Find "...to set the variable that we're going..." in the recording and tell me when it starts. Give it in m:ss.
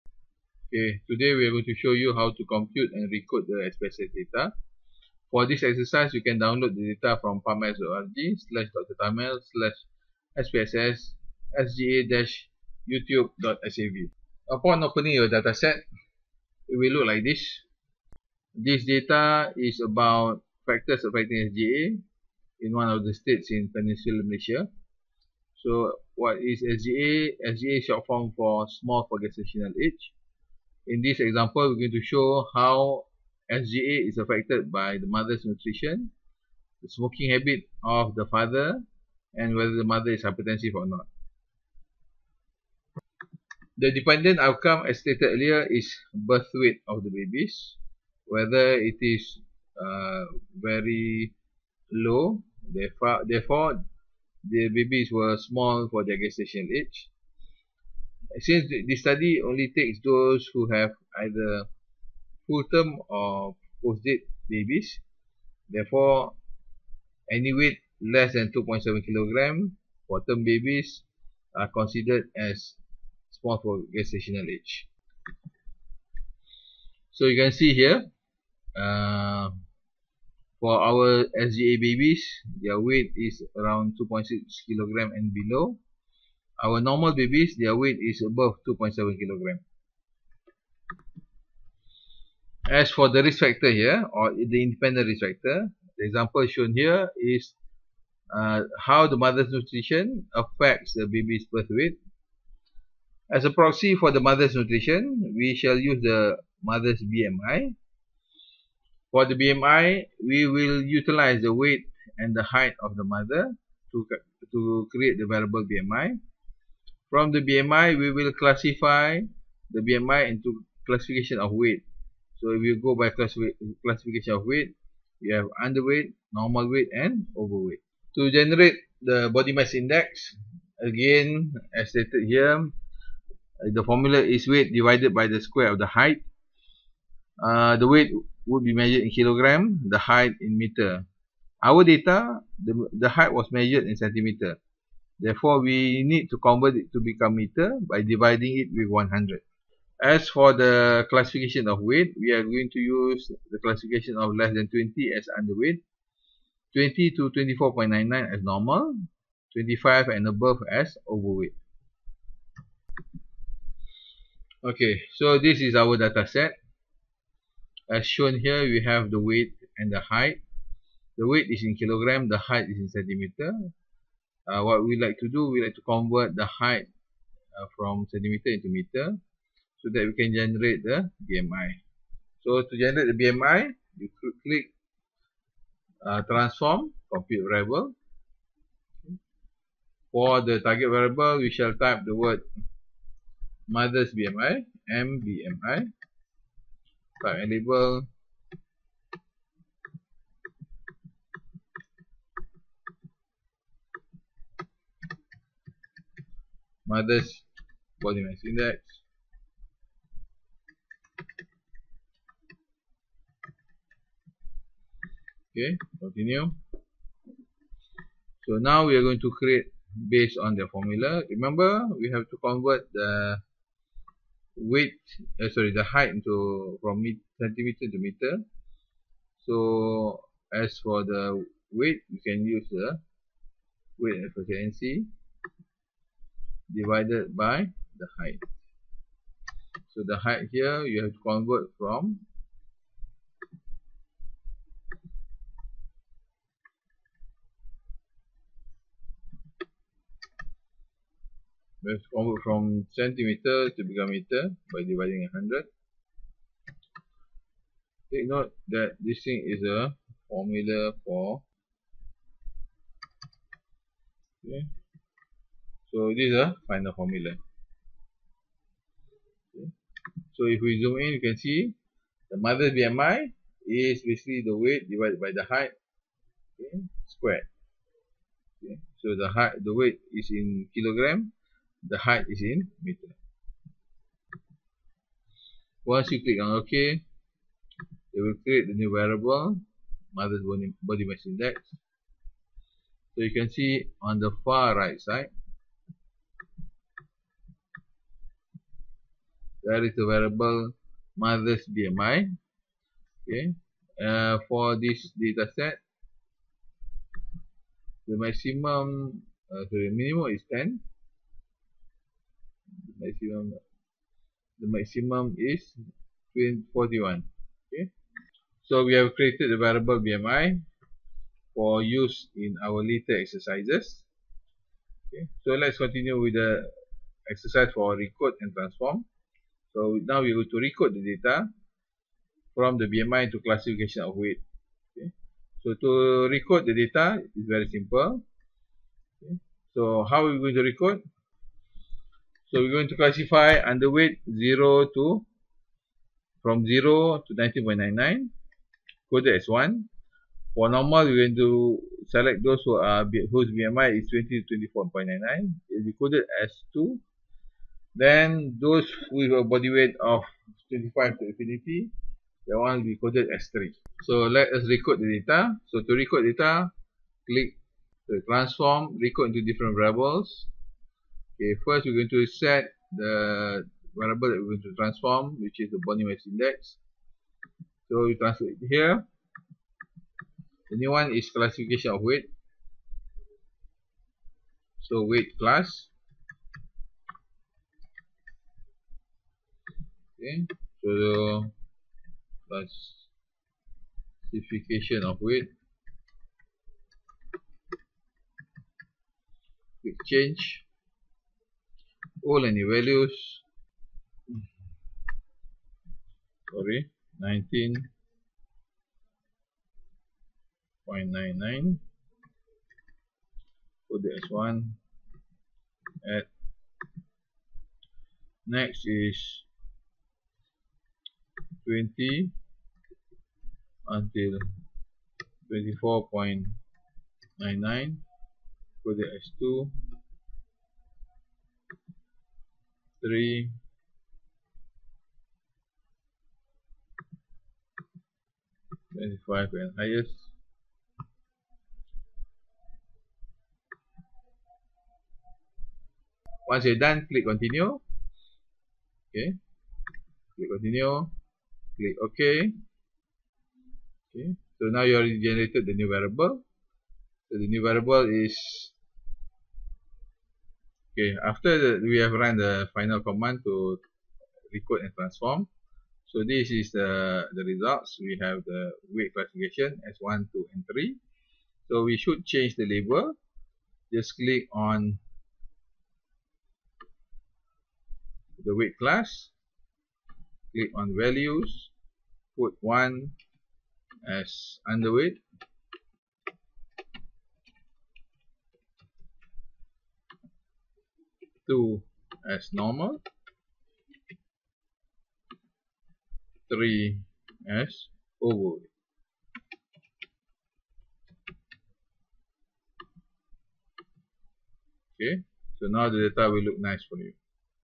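6:12.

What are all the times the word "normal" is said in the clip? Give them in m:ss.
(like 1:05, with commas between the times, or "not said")
1:26, 2:06, 2:38, 5:50, 8:12.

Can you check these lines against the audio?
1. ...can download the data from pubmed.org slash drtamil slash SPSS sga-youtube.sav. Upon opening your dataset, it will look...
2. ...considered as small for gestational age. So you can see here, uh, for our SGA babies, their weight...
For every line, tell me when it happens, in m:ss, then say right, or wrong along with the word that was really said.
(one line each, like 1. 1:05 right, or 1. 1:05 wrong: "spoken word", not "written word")
1. 0:06 right
2. 1:11 right.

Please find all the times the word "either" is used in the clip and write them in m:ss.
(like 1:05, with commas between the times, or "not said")
1:01.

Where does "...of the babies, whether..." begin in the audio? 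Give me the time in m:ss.
0:46.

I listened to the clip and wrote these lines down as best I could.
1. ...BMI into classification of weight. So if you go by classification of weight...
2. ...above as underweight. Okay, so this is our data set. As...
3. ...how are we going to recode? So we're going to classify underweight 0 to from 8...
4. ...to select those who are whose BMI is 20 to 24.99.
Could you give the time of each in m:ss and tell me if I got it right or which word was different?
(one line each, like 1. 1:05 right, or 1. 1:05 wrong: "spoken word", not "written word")
1. 1:59 right
2. 2:40 wrong: "overweight", not "underweight"
3. 5:40 wrong: "0", not "8"
4. 5:51 right.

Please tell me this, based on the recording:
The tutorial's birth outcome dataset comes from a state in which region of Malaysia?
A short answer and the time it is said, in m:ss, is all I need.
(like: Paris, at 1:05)
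Peninsular Malaysia, at 0:23.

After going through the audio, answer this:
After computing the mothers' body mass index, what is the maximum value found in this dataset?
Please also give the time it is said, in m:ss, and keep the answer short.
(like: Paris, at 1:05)
41, at 5:16.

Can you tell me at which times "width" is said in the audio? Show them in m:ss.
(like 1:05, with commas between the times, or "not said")
3:44, 3:51.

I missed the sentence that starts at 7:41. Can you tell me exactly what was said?
After the, we have run the final command to recode and transform.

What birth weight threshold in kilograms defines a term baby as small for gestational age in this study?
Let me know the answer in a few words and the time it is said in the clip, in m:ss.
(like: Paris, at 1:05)
2.7 kg, at 1:08.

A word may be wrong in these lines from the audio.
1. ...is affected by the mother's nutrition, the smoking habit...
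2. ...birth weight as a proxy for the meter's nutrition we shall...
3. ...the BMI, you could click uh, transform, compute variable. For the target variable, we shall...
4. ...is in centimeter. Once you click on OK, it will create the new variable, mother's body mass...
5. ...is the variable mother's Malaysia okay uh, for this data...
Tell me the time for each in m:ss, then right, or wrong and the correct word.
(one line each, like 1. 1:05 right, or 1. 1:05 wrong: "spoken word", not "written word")
1. 0:34 right
2. 1:41 wrong: "mother", not "meter"
3. 3:03 right
4. 4:42 wrong: "meter", not "centimeter"
5. 4:59 wrong: "BMI", not "Malaysia".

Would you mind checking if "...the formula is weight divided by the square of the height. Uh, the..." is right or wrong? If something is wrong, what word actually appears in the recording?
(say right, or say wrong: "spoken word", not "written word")
right.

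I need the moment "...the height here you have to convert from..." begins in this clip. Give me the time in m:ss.
4:00.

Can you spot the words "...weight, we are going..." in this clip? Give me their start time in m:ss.
2:31.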